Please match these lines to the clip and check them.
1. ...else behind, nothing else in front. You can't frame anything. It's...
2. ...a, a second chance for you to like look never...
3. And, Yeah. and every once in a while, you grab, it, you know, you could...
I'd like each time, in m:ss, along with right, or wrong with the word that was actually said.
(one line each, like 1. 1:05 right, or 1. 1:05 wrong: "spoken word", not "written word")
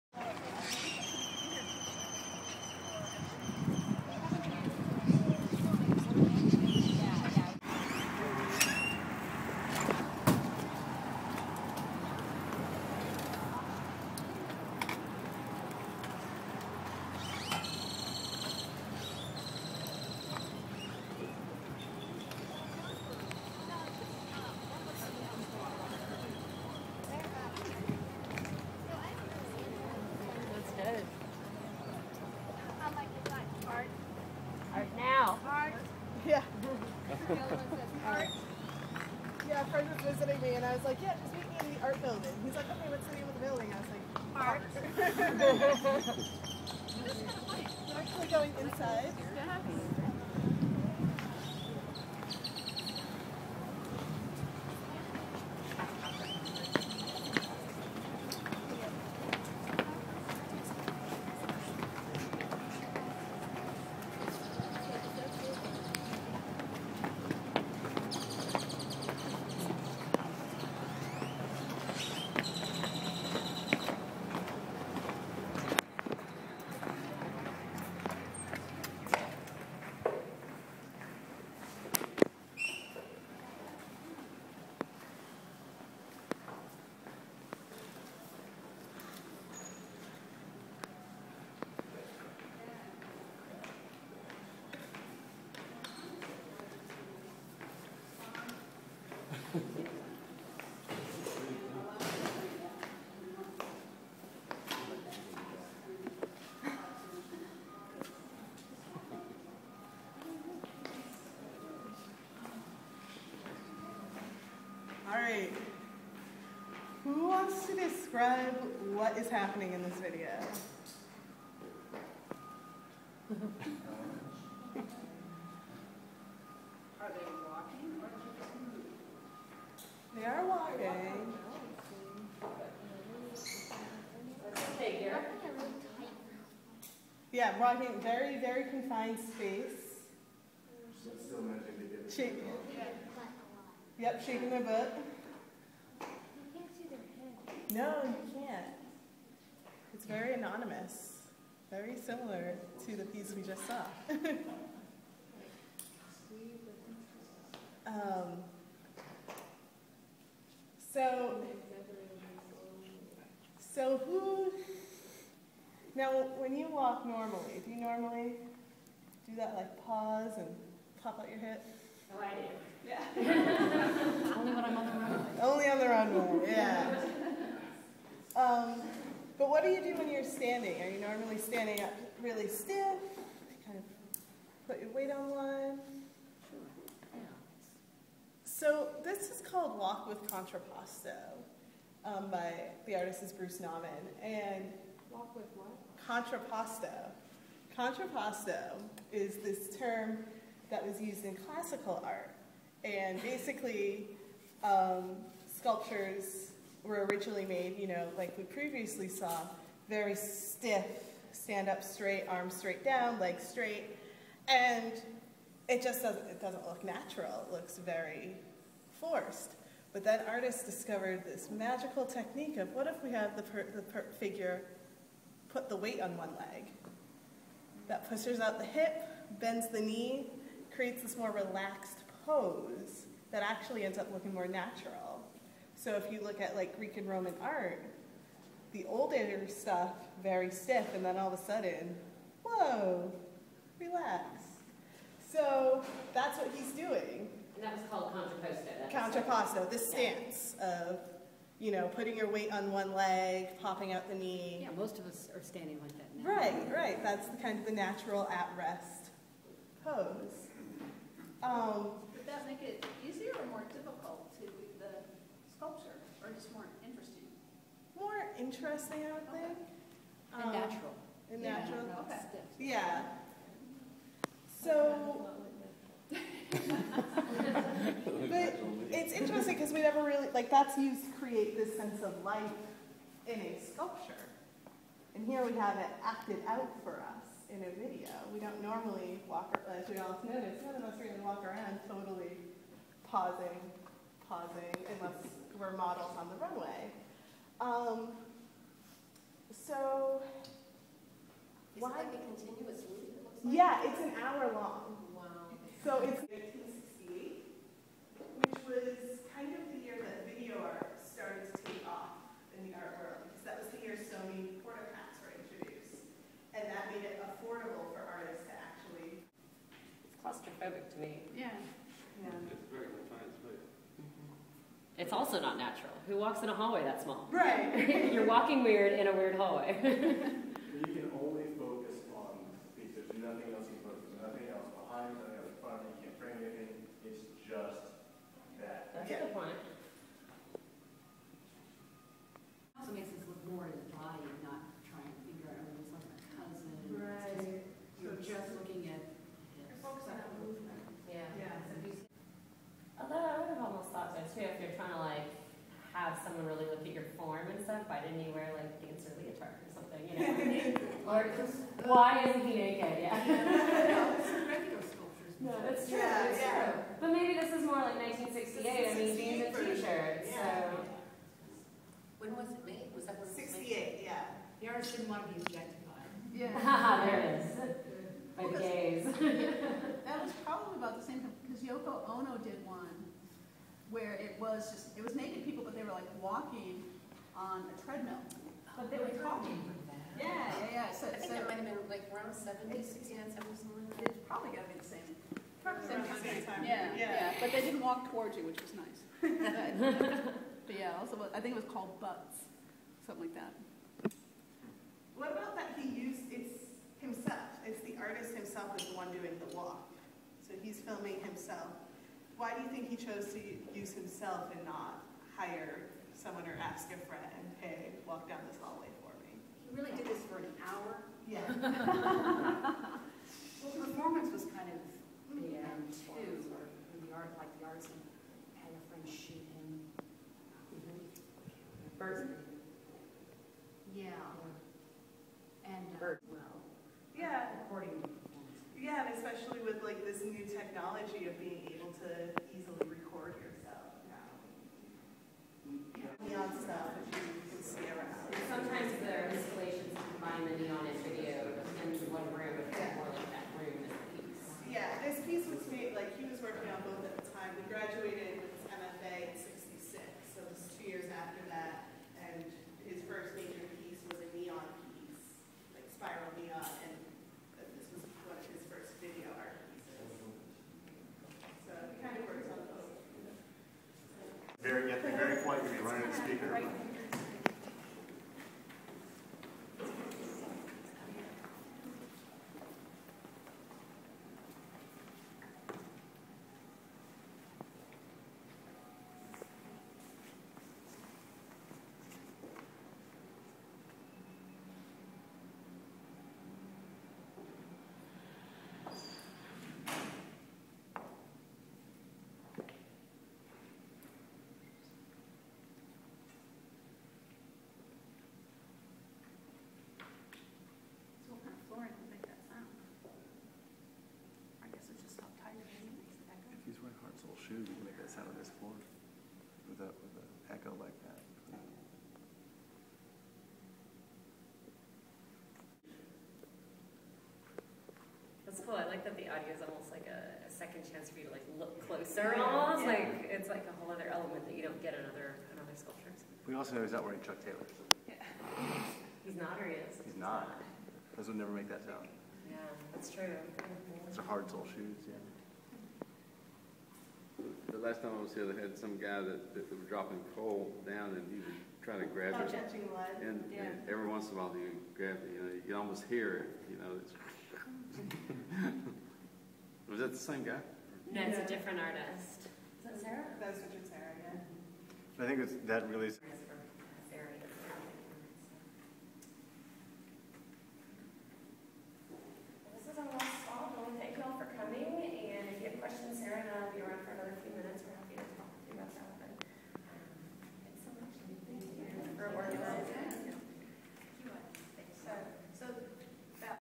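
1. 5:34 right
2. 8:50 wrong: "closer", not "never"
3. 9:13 right.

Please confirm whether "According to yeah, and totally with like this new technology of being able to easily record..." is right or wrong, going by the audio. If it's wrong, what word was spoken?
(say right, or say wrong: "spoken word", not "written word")
wrong: "especially", not "totally".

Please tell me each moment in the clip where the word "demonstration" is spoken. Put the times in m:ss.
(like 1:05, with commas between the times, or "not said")
not said.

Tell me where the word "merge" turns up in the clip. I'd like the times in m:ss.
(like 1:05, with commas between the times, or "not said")
not said.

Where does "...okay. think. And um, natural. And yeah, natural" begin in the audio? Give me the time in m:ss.
4:29.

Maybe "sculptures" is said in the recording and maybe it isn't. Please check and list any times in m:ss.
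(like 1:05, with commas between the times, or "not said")
3:25, 4:25, 4:43, 8:55.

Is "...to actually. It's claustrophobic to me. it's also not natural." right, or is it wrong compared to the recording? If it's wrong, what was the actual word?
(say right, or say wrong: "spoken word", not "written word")
right.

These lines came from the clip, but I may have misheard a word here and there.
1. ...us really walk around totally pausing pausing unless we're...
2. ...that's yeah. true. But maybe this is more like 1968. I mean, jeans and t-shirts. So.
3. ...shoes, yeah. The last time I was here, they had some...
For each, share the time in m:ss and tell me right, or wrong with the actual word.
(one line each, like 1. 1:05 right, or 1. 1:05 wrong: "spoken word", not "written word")
1. 4:50 right
2. 6:06 right
3. 9:04 right.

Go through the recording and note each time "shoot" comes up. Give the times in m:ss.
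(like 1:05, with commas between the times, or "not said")
7:09.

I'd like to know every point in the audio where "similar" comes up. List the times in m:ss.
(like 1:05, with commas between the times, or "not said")
2:31.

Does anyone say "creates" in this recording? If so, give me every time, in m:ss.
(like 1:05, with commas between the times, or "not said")
3:50, 4:41.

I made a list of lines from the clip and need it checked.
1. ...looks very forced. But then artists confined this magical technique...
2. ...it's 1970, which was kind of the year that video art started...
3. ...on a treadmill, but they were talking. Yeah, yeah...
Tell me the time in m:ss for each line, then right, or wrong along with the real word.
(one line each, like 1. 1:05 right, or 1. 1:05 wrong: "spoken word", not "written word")
1. 3:37 wrong: "discovered", not "confined"
2. 5:06 wrong: "1968", not "1970"
3. 6:27 right.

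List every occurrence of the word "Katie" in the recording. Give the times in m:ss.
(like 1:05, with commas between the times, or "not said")
not said.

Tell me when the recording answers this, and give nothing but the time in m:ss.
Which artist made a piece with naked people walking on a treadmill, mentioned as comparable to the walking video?
6:21.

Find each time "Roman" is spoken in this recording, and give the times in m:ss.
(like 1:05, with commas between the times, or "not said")
3:57.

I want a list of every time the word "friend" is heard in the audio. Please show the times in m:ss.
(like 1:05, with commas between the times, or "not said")
0:39, 6:57, 7:08.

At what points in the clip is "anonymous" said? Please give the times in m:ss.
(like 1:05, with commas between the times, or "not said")
2:30.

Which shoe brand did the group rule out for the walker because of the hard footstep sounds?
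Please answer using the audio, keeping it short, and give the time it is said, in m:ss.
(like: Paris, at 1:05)
Chuck Taylor, at 8:57.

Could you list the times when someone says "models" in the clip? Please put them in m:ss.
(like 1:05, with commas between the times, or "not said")
4:55.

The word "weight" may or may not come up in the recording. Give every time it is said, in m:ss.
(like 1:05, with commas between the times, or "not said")
3:04, 3:45, 4:12.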